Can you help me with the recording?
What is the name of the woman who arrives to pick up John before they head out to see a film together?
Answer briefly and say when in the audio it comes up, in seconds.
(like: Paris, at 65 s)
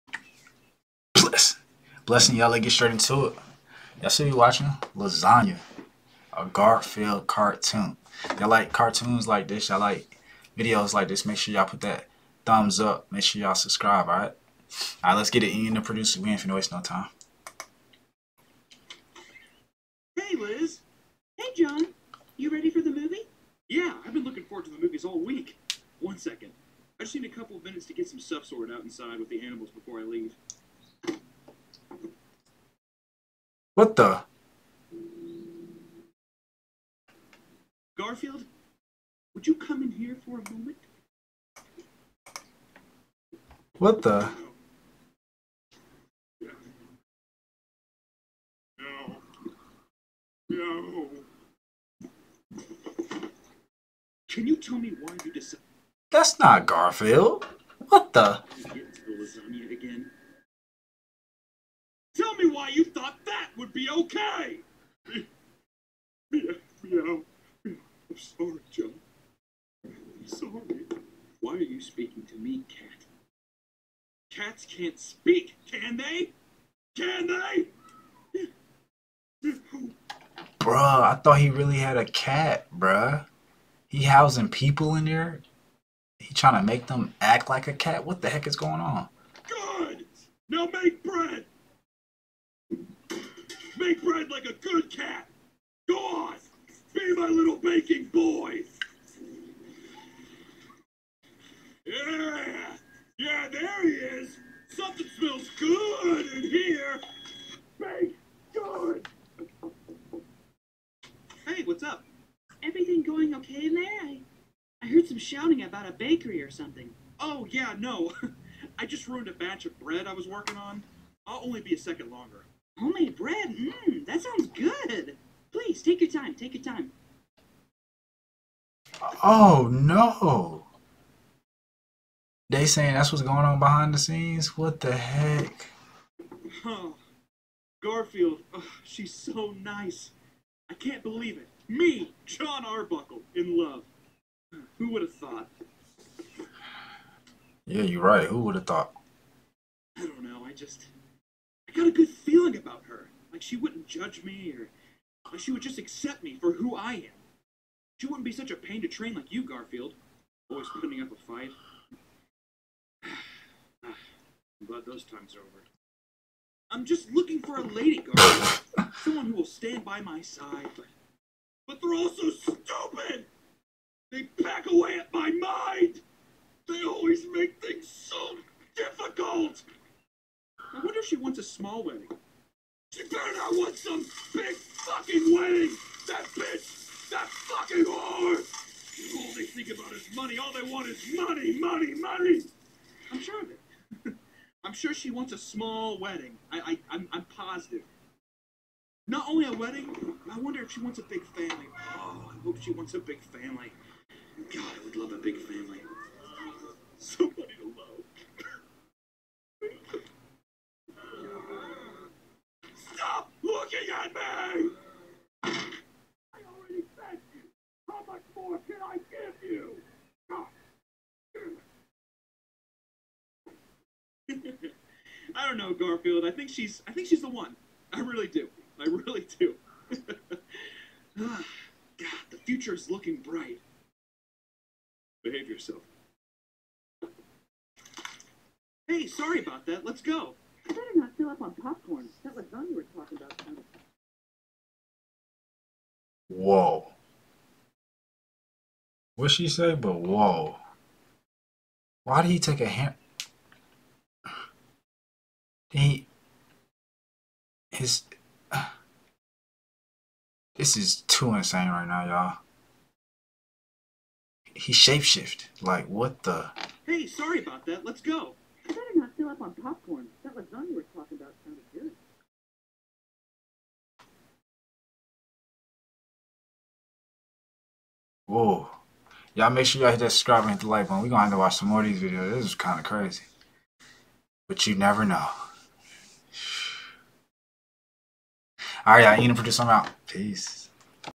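Liz, at 20 s.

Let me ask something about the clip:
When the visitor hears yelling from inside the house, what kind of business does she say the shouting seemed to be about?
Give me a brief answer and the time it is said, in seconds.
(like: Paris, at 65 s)
A bakery, at 115 s.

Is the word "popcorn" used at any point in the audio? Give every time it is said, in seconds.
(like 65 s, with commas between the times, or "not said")
241 s, 269 s.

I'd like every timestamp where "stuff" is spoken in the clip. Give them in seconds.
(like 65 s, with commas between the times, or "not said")
28 s.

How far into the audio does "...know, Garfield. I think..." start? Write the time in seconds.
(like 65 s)
225 s.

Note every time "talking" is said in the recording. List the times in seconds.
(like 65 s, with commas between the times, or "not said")
242 s, 270 s.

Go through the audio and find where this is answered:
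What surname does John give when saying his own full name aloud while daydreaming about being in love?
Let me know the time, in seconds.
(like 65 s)
142 s.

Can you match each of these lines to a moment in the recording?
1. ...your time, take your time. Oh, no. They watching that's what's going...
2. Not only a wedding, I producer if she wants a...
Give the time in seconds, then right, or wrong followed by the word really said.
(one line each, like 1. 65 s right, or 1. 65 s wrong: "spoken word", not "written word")
1. 126 s wrong: "saying", not "watching"
2. 199 s wrong: "wonder", not "producer".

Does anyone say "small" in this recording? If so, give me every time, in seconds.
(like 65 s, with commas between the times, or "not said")
181 s, 195 s.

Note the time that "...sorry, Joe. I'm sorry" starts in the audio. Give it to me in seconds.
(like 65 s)
68 s.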